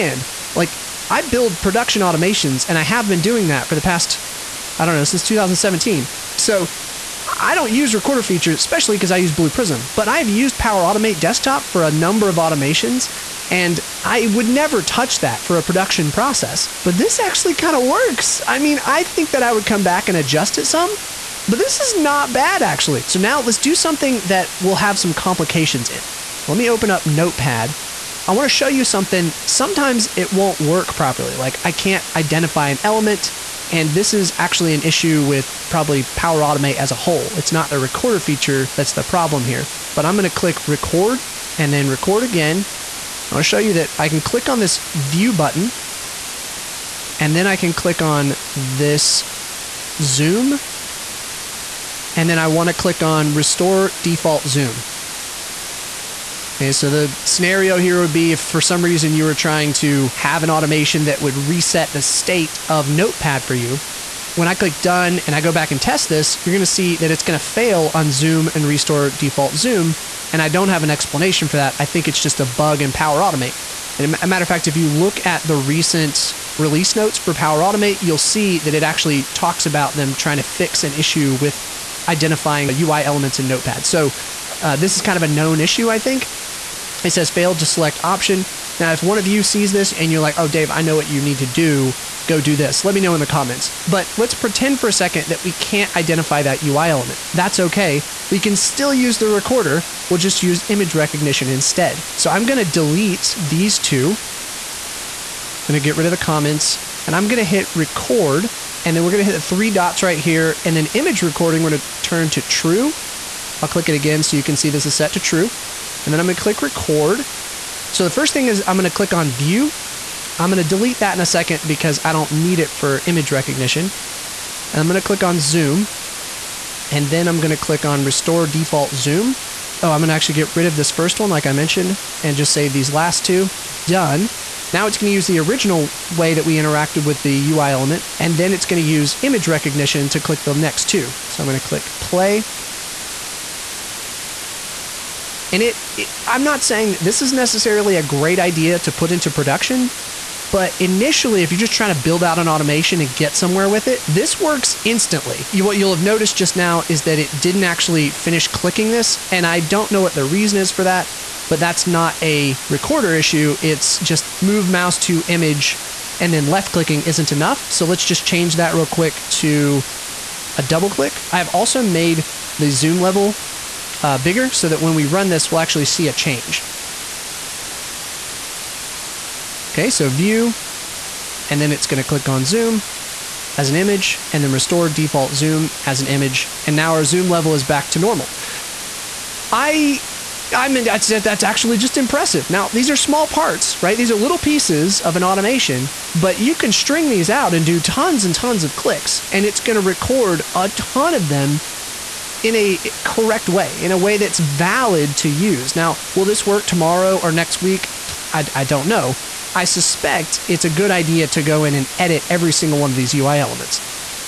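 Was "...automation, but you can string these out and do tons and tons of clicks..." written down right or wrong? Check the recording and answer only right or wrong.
right.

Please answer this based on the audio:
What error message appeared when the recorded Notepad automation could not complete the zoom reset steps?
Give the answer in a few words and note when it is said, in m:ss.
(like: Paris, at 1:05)
Failed to select option, at 1:27.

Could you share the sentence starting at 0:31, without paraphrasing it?
Like I can't identify an element.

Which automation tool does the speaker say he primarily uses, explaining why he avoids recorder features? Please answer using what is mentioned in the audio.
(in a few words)
Blue Prism.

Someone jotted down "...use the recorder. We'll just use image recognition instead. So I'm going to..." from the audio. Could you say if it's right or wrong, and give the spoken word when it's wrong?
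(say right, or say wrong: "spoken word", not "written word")
right.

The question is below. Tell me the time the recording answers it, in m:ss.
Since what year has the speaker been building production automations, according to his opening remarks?
0:05.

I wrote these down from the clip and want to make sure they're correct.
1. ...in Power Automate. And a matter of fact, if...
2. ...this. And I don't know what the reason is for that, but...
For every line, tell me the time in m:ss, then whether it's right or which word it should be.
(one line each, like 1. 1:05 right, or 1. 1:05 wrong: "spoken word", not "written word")
1. 1:12 right
2. 2:38 right.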